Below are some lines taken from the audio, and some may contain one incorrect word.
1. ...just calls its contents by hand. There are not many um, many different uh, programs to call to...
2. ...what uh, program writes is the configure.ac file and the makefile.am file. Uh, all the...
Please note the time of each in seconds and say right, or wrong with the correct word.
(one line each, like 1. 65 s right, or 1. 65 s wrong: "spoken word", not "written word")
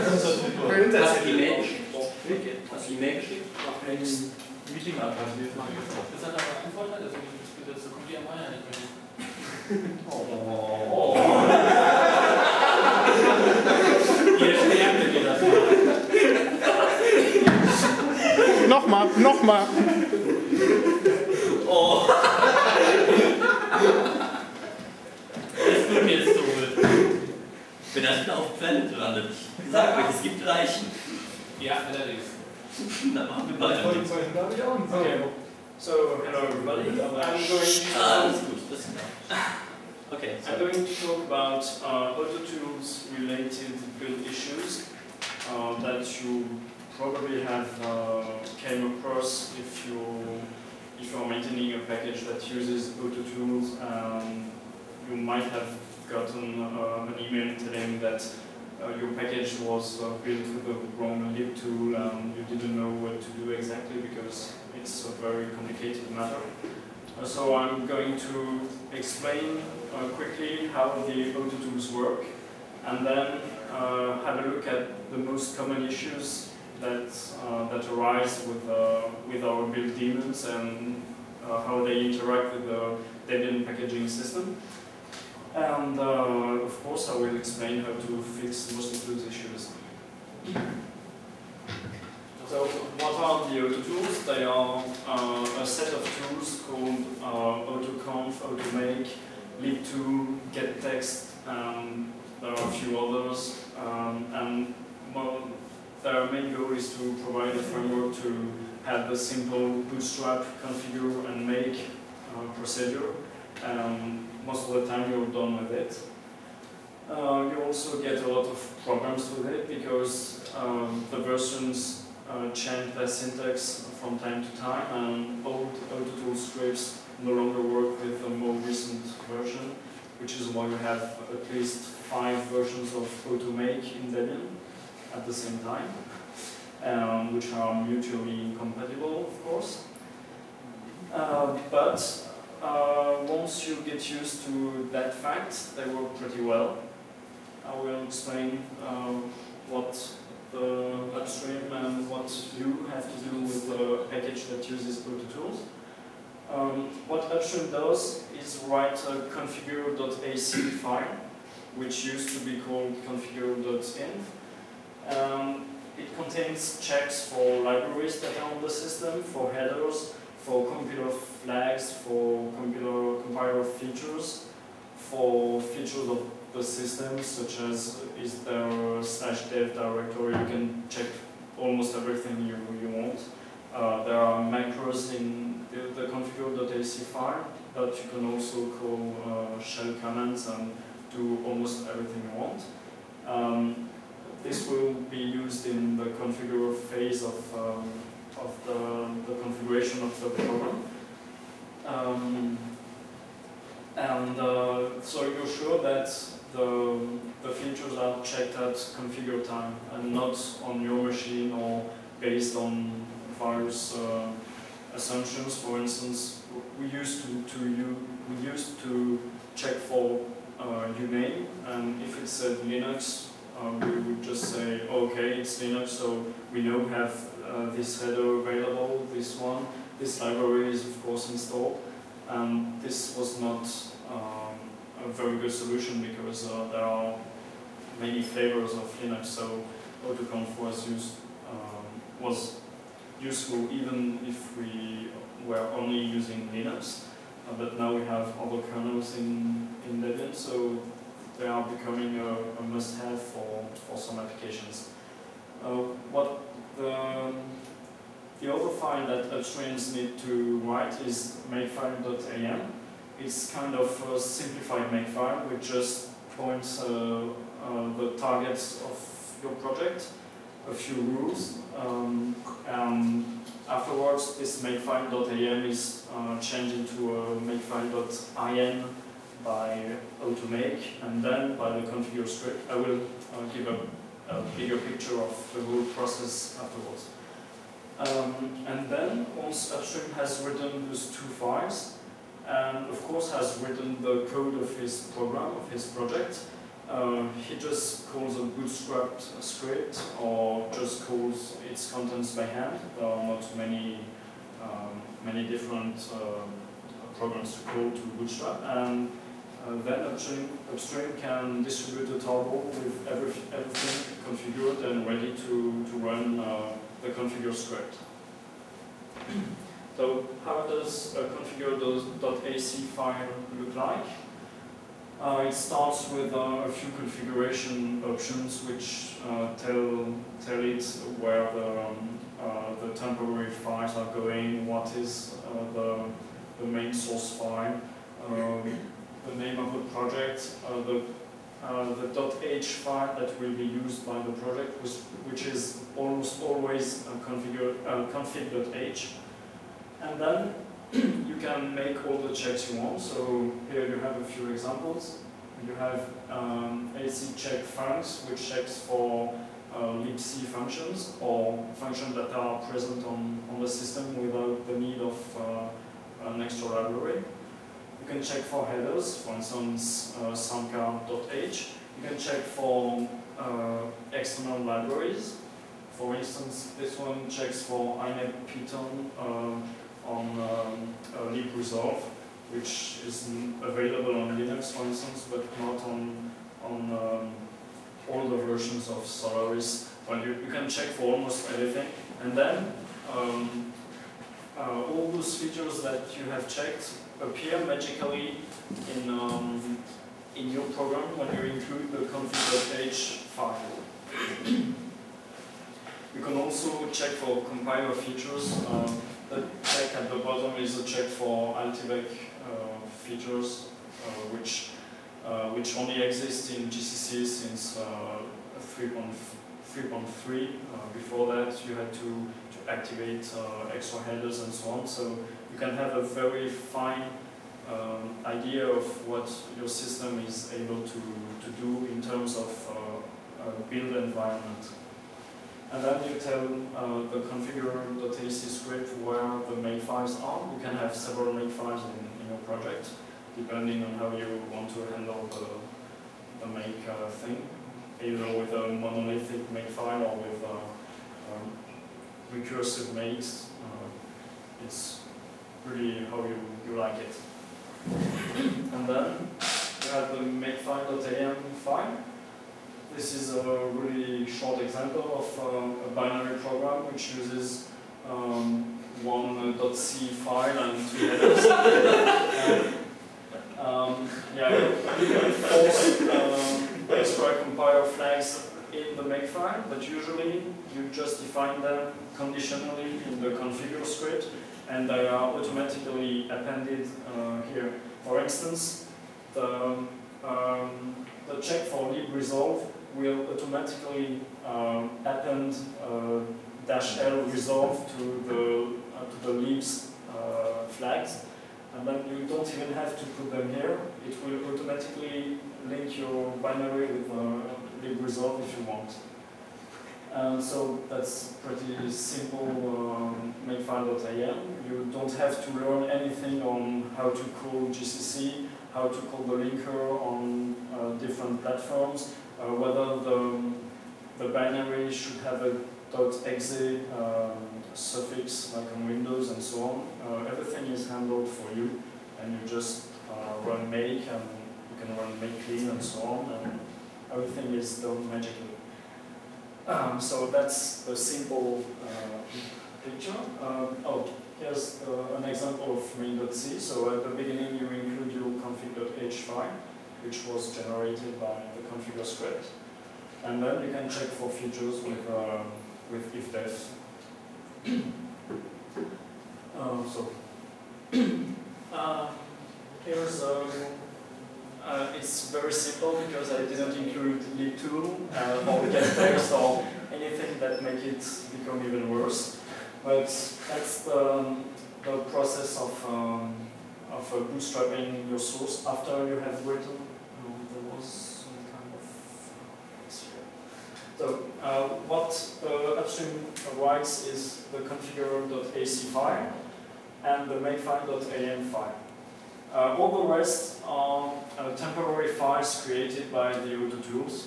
1. 300 s right
2. 584 s wrong: "upstream", not "program".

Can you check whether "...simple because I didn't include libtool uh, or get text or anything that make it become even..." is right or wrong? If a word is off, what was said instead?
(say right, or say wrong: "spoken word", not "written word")
right.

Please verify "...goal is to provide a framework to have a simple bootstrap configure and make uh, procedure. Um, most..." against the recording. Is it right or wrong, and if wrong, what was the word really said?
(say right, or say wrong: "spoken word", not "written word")
right.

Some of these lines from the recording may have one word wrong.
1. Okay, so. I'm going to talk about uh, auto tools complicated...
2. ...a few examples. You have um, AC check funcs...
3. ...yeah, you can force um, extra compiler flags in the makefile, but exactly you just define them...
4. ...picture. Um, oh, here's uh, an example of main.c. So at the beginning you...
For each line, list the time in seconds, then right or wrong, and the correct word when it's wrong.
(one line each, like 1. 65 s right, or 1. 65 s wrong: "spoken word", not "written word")
1. 40 s wrong: "related", not "complicated"
2. 354 s right
3. 474 s wrong: "usually", not "exactly"
4. 542 s right.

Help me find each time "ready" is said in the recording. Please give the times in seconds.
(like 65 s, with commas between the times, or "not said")
315 s.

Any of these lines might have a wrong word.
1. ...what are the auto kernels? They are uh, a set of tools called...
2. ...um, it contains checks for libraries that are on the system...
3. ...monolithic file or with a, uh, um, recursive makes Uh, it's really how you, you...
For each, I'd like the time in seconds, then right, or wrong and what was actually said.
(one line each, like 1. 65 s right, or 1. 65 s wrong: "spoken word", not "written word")
1. 92 s wrong: "tools", not "kernels"
2. 165 s right
3. 448 s right.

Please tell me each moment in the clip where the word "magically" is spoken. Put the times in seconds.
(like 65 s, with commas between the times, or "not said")
397 s, 538 s.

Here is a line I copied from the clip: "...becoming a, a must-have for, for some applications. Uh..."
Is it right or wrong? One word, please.
right.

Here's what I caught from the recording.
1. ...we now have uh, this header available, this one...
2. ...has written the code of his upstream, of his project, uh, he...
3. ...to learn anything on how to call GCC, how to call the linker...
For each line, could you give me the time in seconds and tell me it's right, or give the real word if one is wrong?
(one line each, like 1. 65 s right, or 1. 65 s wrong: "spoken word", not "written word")
1. 226 s right
2. 293 s wrong: "program", not "upstream"
3. 515 s right.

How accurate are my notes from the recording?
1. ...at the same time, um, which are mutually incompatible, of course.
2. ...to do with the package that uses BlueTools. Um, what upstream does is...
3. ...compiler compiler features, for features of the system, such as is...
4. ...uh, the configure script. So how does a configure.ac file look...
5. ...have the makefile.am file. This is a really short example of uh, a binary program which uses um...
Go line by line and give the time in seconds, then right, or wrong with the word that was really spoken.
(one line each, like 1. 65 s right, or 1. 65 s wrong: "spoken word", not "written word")
1. 135 s right
2. 153 s right
3. 172 s right
4. 316 s right
5. 459 s right.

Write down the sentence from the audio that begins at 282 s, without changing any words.
I will uh, give a, a, bigger picture of the whole process afterwards.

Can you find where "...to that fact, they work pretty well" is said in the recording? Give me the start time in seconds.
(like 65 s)
144 s.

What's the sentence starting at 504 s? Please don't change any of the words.
It will automatically link your binary with the uh, big result if you want.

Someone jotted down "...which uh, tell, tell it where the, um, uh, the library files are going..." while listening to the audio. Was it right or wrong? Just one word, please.
wrong.